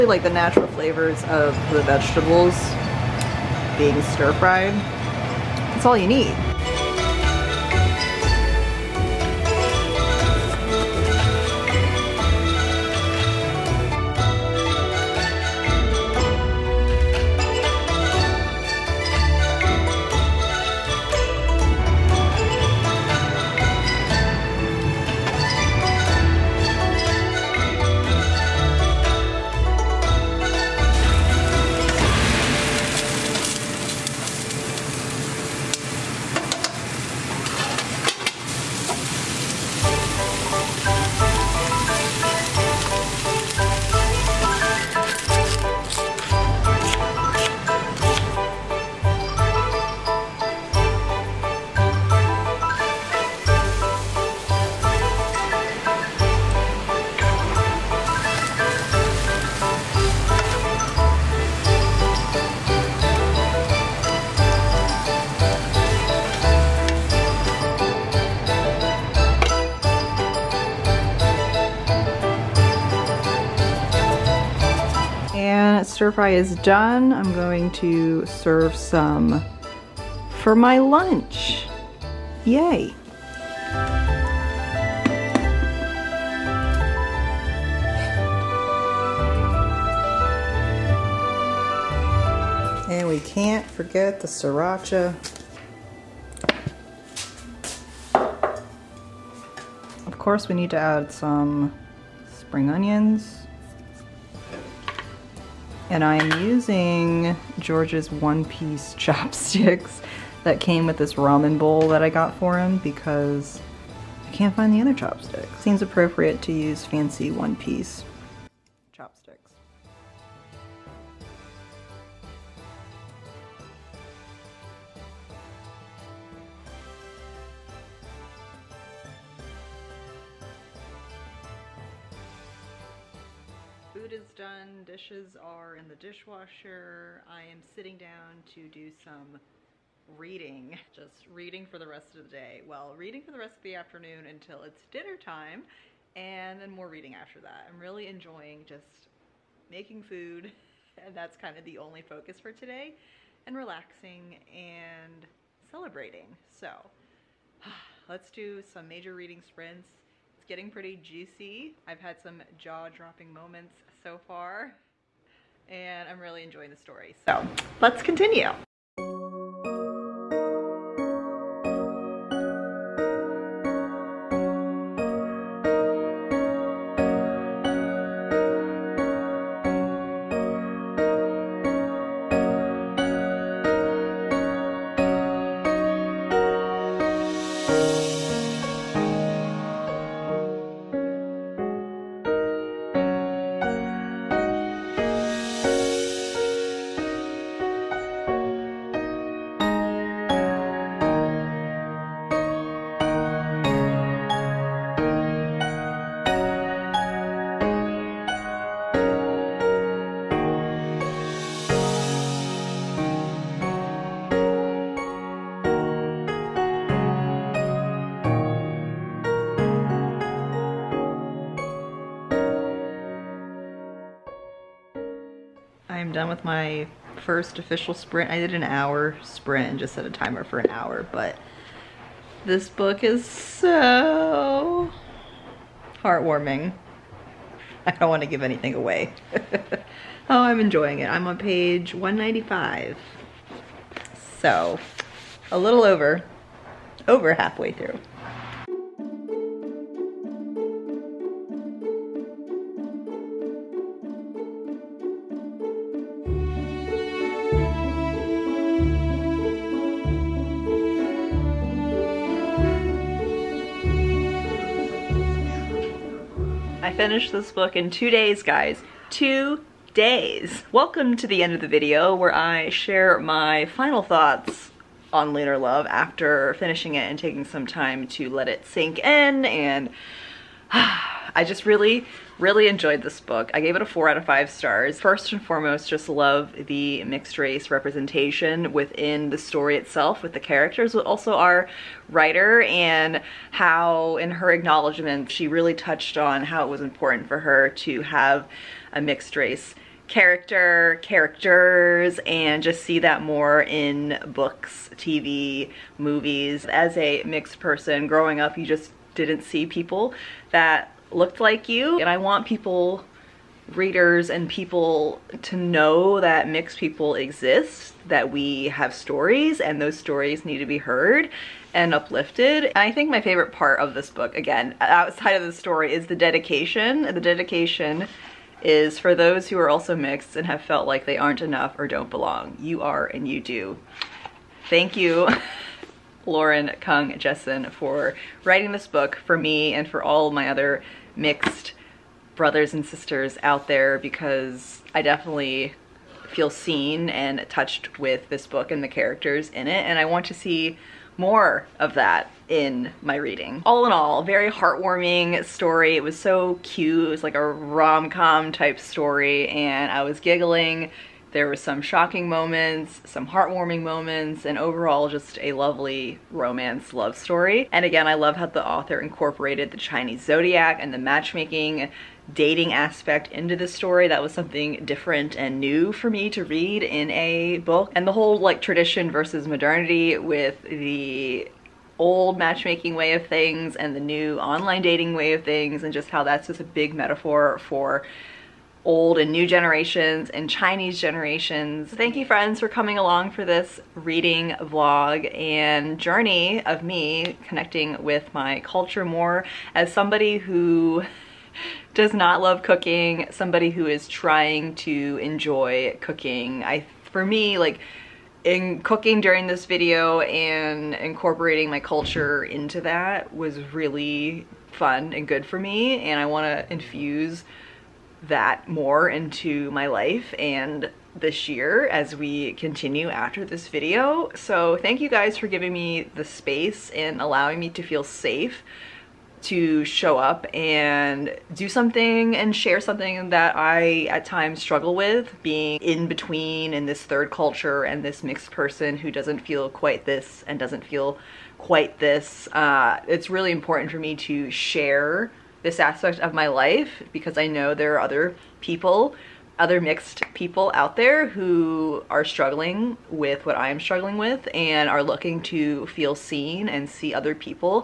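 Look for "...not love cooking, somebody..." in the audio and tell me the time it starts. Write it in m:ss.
6:42.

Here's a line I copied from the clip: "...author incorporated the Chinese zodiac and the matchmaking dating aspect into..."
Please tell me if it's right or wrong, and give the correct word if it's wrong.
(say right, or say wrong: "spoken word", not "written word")
right.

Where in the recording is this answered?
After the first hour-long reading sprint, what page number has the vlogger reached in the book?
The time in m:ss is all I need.
4:01.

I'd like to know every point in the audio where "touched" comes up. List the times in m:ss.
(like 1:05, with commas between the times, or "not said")
4:55, 5:47.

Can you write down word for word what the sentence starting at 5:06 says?
As a mixed person growing up, you just didn't see people that looked like you.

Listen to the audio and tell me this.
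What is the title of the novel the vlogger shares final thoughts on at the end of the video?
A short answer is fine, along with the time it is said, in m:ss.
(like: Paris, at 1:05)
Lunar Love, at 4:35.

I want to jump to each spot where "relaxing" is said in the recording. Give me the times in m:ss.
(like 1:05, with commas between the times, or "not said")
2:33.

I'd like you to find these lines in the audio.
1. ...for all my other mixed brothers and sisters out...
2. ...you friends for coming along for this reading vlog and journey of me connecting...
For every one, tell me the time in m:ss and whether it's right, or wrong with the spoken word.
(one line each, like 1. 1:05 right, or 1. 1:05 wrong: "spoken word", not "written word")
1. 5:39 right
2. 6:32 right.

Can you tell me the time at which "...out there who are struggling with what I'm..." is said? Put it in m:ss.
7:30.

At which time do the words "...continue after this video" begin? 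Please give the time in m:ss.
7:02.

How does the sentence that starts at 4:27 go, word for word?
finish this book in two days, guys.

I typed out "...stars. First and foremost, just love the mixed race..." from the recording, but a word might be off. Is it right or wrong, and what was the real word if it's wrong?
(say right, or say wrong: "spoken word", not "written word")
right.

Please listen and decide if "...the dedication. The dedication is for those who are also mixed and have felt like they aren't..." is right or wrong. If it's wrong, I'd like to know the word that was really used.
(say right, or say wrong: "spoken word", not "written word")
right.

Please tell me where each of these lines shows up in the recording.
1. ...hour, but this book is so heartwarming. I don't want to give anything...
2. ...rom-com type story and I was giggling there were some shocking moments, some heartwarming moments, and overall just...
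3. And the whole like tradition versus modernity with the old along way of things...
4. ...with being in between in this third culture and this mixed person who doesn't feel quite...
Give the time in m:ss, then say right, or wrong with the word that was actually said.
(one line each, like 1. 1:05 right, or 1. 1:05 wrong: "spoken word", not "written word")
1. 3:50 right
2. 5:57 right
3. 6:17 wrong: "matchmaking", not "along"
4. 7:14 right.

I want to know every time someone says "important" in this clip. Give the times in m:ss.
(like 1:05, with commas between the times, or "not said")
4:56, 7:23.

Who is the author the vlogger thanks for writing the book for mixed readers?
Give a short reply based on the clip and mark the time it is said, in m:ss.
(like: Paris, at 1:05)
Lauren Kung Jessen, at 5:36.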